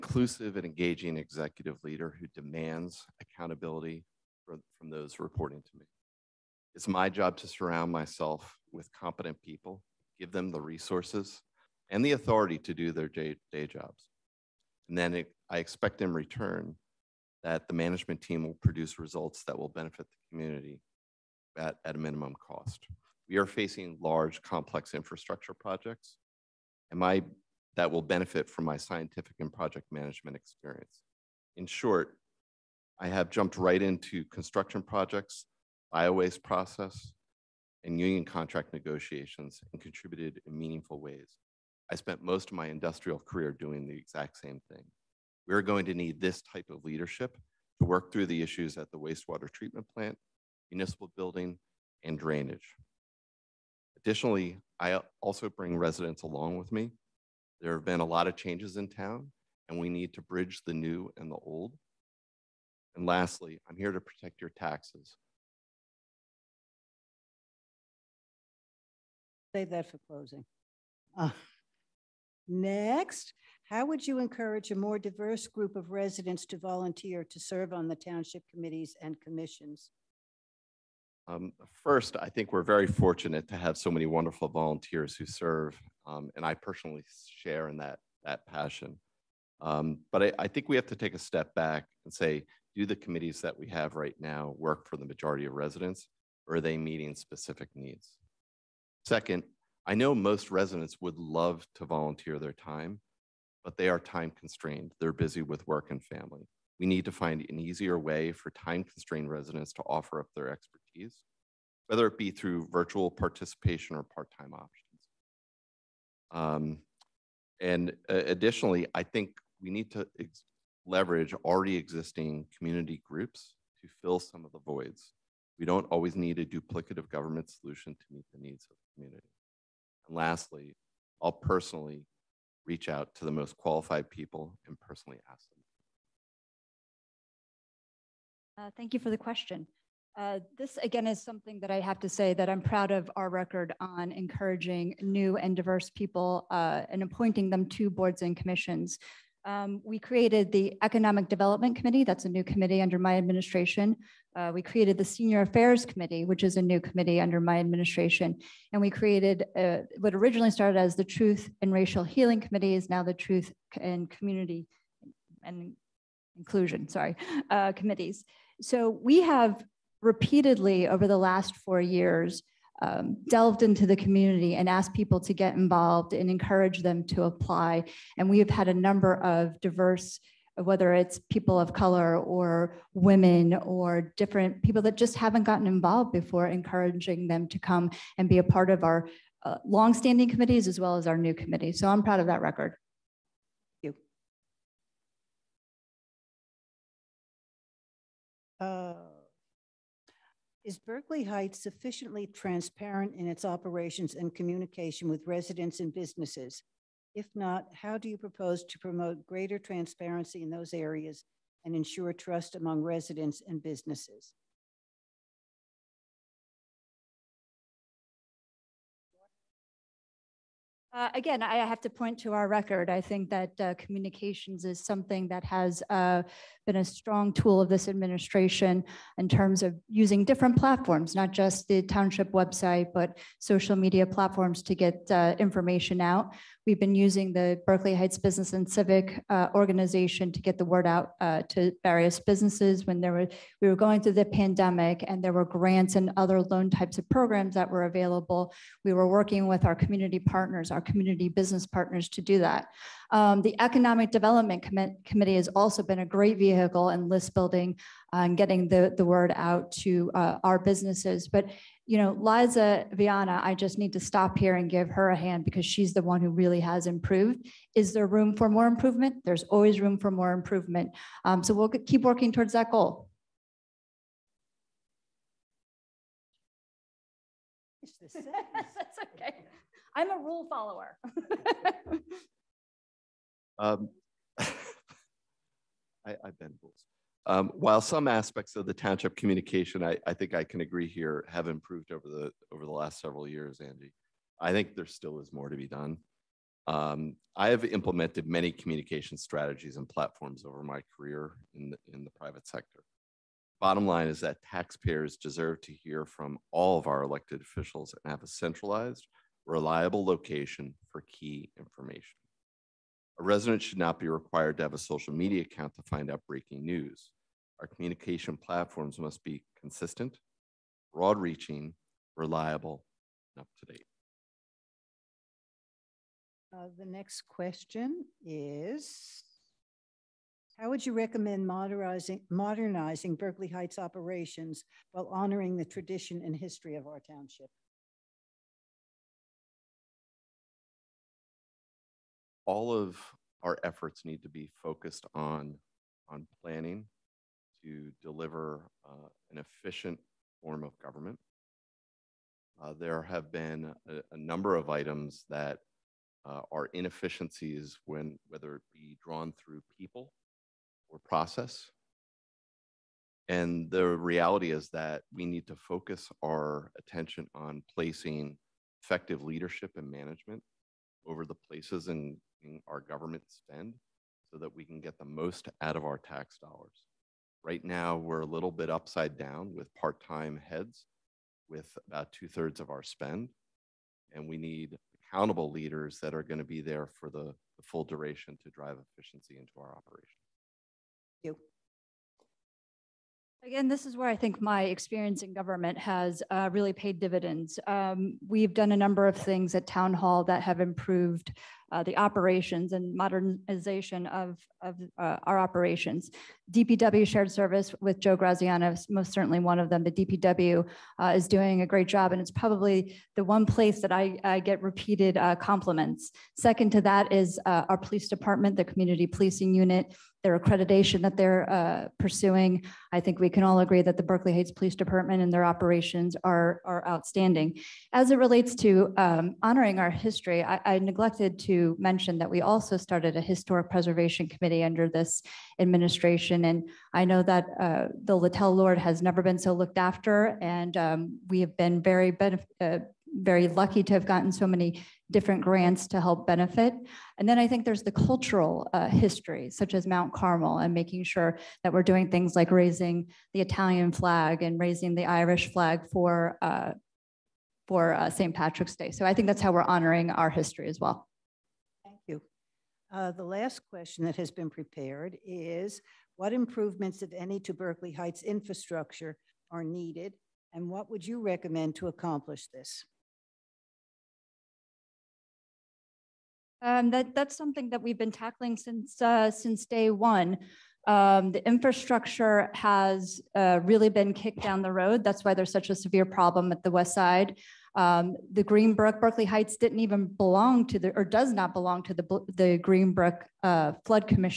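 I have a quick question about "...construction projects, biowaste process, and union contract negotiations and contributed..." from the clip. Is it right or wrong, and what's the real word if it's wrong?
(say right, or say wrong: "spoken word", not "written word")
right.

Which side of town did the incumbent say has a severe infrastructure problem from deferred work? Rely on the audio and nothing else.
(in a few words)
West Side.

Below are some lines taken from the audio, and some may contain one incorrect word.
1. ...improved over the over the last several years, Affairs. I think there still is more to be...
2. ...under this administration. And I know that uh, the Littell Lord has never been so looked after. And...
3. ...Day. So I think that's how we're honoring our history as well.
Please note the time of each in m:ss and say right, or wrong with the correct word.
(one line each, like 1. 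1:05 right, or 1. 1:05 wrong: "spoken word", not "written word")
1. 4:51 wrong: "Angie", not "Affairs"
2. 7:14 right
3. 7:38 right.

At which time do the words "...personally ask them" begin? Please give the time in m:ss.
2:14.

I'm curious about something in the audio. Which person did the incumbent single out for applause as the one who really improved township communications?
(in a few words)
Liza Viana.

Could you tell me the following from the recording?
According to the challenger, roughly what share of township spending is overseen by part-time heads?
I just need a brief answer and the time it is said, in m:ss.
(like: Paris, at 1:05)
two thirds, at 6:22.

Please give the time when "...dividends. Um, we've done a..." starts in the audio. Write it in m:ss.
6:36.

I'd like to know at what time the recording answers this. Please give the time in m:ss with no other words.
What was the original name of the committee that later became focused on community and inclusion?
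2:41.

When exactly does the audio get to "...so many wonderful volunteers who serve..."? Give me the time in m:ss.
1:23.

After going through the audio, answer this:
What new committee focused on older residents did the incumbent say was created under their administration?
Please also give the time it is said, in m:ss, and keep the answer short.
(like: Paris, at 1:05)
Senior Affairs Committee, at 2:35.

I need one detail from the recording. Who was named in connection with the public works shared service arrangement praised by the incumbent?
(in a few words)
Joe Graziano.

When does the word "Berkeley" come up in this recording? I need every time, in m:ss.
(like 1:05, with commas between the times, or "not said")
3:20, 3:57, 5:33, 7:04, 7:47, 8:08.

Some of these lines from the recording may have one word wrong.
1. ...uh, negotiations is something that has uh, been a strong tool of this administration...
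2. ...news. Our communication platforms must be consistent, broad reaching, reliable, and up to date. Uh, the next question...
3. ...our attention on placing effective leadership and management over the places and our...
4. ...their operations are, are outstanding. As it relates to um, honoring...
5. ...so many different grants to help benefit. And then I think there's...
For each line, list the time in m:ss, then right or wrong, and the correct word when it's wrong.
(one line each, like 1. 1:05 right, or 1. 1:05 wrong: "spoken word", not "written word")
1. 3:43 wrong: "communications", not "negotiations"
2. 5:16 right
3. 6:06 right
4. 7:05 right
5. 7:24 right.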